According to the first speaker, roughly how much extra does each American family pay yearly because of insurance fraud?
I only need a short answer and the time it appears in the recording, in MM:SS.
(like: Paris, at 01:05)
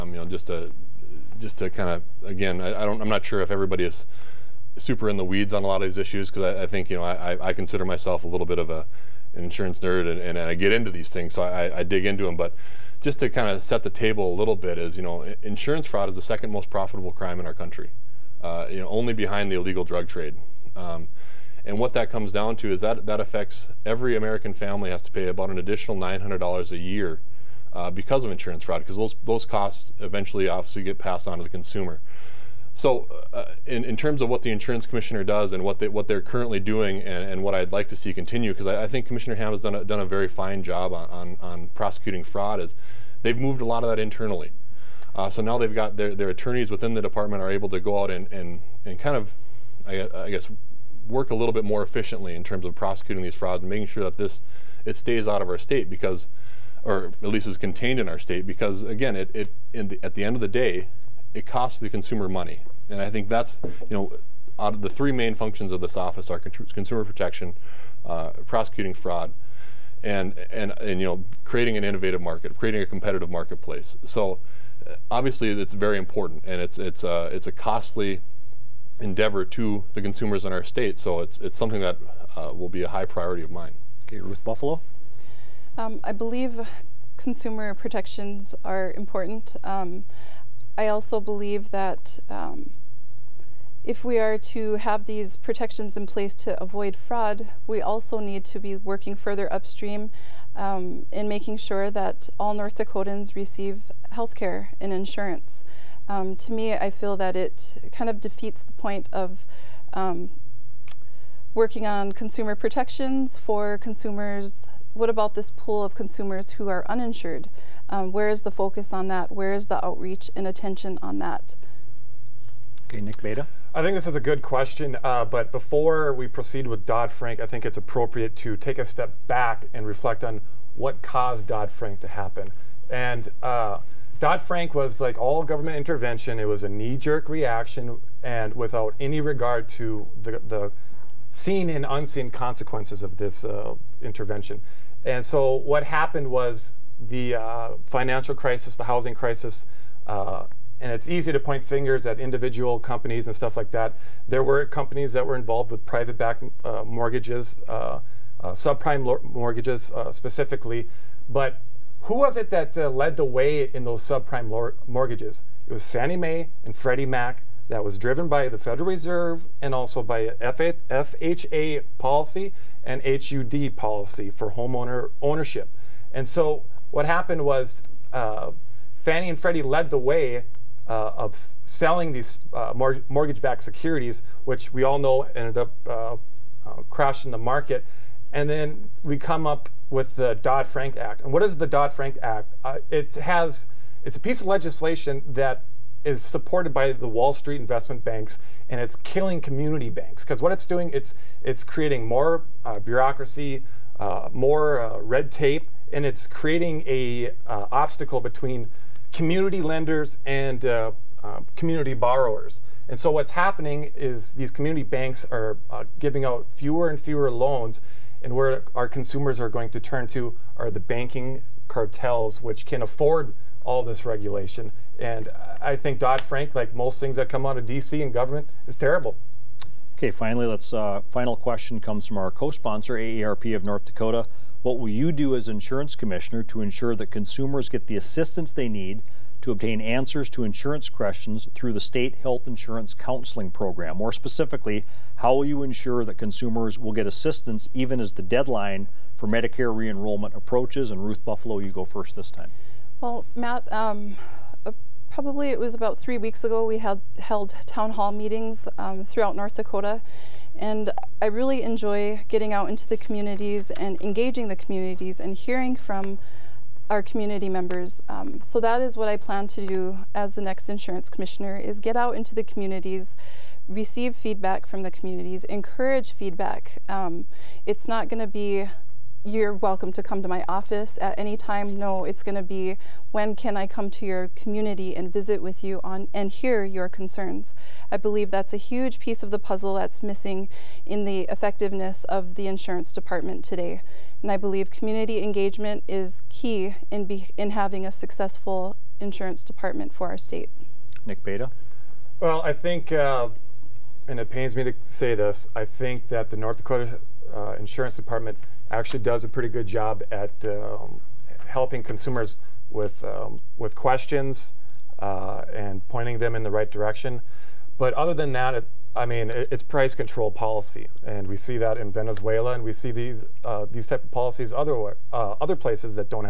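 $900, at 00:25.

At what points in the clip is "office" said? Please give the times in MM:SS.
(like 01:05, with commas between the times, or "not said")
01:05, 04:40.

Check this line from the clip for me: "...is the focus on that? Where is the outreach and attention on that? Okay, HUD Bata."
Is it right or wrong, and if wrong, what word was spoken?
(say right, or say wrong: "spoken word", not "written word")
wrong: "Nick", not "HUD".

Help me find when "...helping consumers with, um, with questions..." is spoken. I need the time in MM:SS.
05:11.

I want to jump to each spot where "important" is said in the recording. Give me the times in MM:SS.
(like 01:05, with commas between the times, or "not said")
01:15, 01:28.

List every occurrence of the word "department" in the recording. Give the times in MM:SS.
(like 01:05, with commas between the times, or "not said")
00:47, 04:52, 04:59, 05:07.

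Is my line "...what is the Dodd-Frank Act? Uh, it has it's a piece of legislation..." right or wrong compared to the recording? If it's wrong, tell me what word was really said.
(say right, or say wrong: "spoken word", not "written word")
right.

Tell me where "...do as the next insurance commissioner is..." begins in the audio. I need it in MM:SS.
04:29.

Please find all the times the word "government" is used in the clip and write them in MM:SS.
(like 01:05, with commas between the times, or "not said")
02:15, 03:48.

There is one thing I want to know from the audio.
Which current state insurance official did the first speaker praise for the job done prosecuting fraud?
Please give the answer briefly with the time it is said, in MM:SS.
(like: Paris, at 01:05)
Commissioner Hamm, at 00:39.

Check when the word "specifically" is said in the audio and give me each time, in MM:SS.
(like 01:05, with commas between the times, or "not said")
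02:40, 04:04.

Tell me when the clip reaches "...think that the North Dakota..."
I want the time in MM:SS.
05:05.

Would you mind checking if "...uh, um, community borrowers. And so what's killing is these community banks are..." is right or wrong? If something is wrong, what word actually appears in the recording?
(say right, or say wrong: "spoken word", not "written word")
wrong: "happening", not "killing".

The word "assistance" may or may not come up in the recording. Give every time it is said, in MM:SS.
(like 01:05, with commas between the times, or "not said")
03:57, 04:07.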